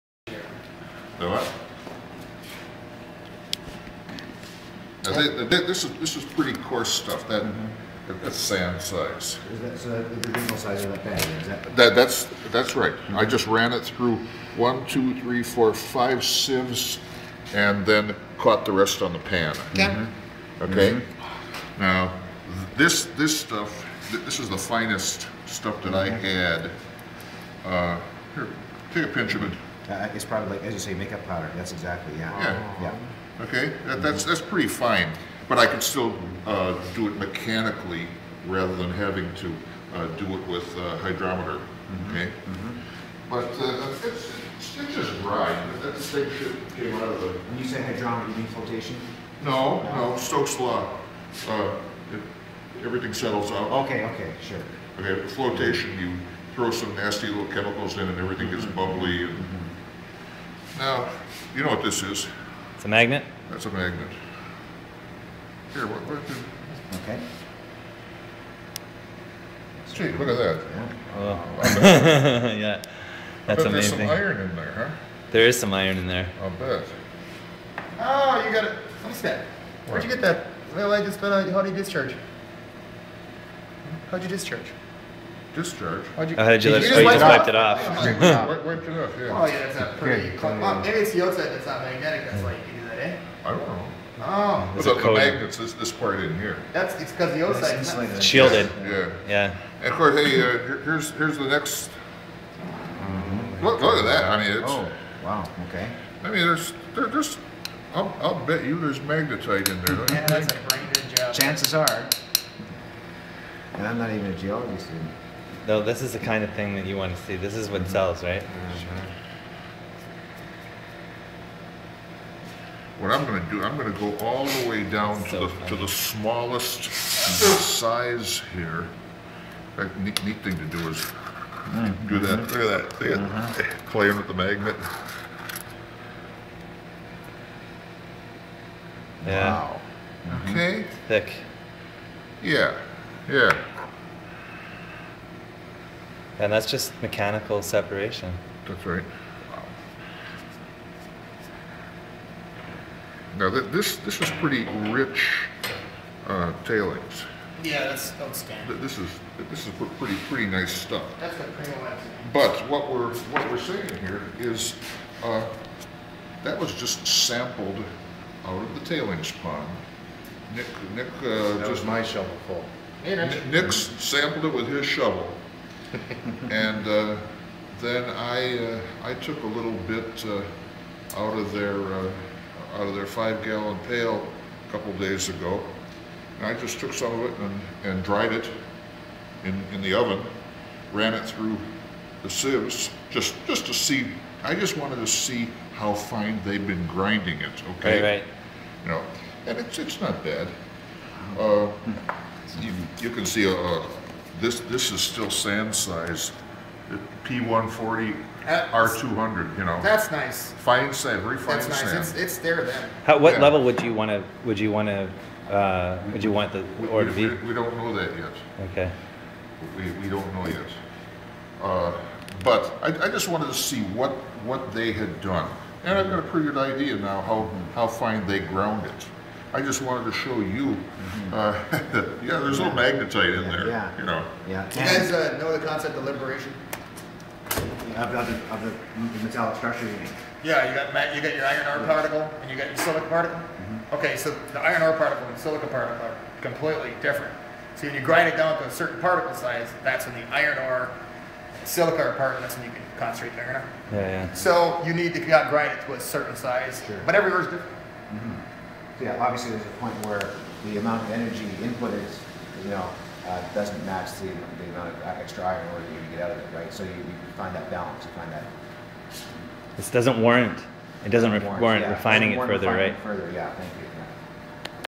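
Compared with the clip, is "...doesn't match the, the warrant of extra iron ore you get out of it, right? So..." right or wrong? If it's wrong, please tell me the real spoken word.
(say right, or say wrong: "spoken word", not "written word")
wrong: "amount", not "warrant".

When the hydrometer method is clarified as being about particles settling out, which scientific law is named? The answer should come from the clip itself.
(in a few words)
Stokes law.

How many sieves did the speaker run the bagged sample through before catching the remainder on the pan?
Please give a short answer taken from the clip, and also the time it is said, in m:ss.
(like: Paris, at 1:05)
5, at 0:15.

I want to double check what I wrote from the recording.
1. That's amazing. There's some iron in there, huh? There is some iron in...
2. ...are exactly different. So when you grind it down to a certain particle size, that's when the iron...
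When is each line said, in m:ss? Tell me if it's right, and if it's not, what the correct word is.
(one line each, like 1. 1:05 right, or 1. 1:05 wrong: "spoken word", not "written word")
1. 1:13 right
2. 4:06 wrong: "completely", not "exactly".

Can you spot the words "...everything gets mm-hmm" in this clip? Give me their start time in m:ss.
0:58.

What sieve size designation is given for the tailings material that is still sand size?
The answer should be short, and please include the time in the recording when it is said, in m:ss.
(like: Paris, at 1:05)
P140, R200, at 3:27.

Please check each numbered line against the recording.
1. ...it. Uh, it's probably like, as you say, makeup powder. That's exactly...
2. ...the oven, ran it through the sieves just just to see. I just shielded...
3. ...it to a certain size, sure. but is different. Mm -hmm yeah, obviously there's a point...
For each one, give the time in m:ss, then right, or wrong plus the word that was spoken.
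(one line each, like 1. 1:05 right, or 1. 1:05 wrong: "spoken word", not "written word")
1. 0:29 right
2. 3:09 wrong: "wanted", not "shielded"
3. 4:15 right.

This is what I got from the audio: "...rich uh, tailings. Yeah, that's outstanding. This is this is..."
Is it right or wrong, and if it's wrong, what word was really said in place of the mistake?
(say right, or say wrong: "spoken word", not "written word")
right.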